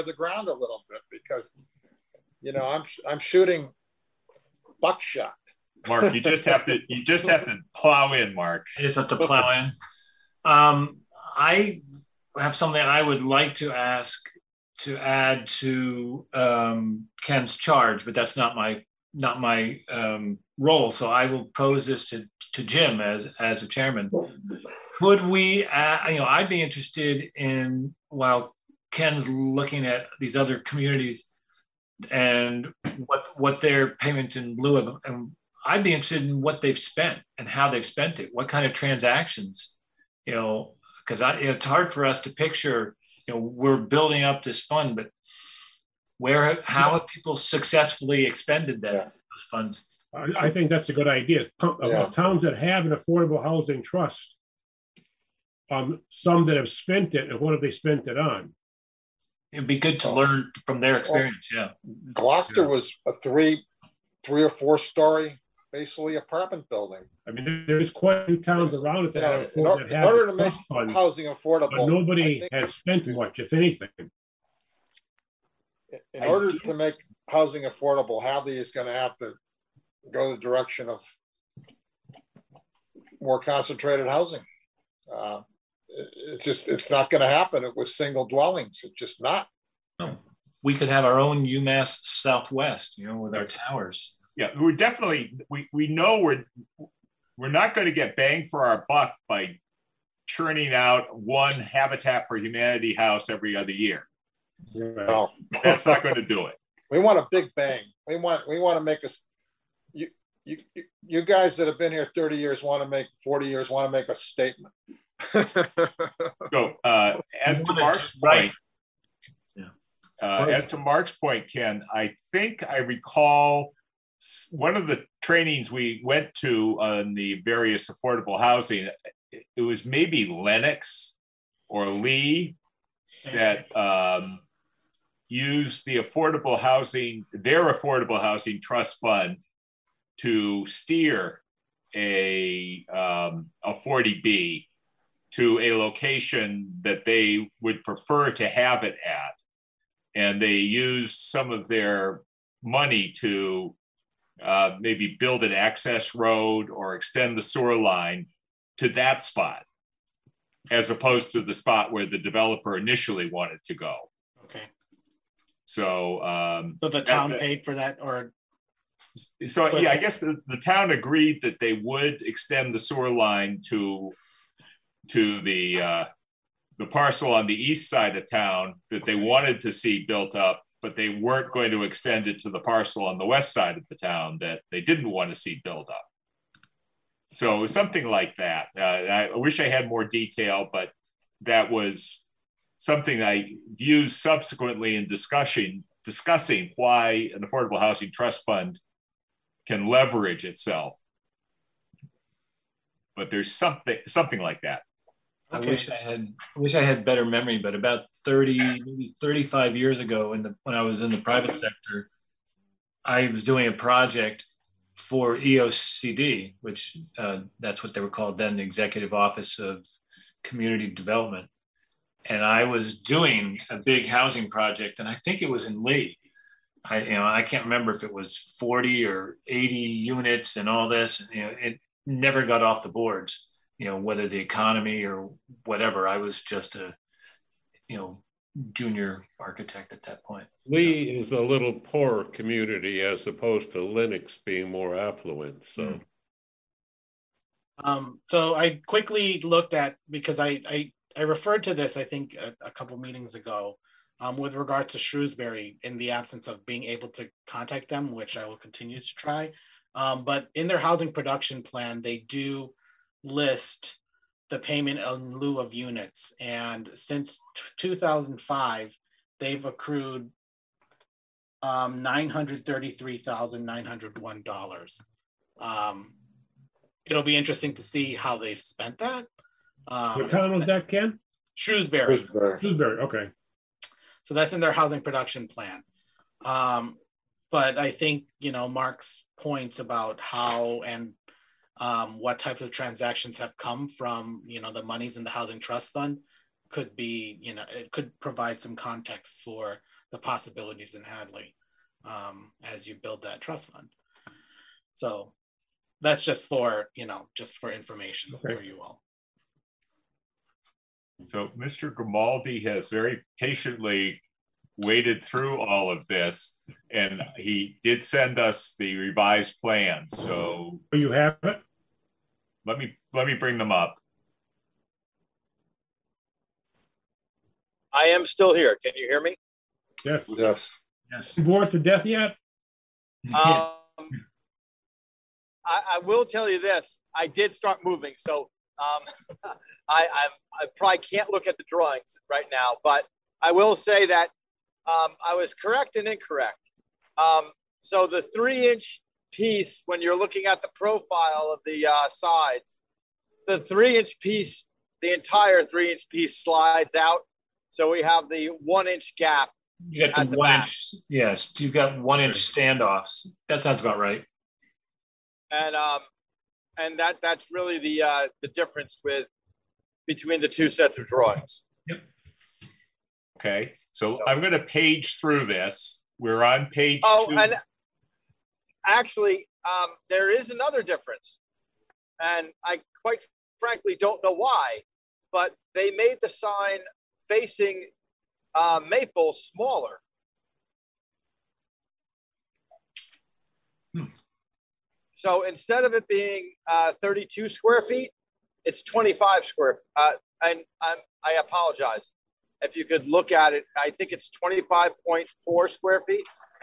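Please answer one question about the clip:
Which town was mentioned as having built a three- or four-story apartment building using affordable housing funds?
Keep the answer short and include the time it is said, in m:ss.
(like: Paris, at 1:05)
Gloucester, at 1:02.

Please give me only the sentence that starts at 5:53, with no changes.
The three inch piece, the entire three inch piece slides out.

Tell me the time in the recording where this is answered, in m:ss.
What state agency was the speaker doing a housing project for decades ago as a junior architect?
3:38.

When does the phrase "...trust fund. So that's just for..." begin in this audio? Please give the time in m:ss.
5:03.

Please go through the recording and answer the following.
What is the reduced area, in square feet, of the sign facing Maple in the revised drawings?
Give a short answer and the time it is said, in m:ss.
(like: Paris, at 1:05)
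25.4 square feet, at 6:44.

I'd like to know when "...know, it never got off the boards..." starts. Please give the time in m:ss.
3:51.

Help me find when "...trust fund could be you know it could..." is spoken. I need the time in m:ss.
4:55.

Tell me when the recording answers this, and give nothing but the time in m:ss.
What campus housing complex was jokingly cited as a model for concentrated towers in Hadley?
1:31.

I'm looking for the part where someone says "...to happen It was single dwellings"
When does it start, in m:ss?
1:27.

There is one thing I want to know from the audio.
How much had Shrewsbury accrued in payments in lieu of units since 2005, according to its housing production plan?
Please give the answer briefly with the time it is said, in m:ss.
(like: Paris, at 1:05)
$933,901, at 4:32.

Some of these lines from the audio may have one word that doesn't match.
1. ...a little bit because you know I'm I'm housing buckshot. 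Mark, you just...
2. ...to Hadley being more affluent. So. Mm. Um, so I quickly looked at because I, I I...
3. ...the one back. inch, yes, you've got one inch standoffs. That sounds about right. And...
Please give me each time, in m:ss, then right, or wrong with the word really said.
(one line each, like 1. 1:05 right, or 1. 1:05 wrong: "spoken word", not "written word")
1. 0:00 wrong: "shooting", not "housing"
2. 4:03 wrong: "Lenox", not "Hadley"
3. 6:00 right.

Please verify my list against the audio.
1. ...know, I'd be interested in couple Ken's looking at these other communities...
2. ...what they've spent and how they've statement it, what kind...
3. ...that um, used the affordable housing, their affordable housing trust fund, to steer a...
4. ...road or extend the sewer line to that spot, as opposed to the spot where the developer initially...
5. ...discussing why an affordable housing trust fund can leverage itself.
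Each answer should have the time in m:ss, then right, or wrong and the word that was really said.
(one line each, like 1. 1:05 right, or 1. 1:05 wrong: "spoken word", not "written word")
1. 0:26 wrong: "while", not "couple"
2. 0:36 wrong: "spent", not "statement"
3. 2:13 right
4. 2:36 right
5. 3:16 right.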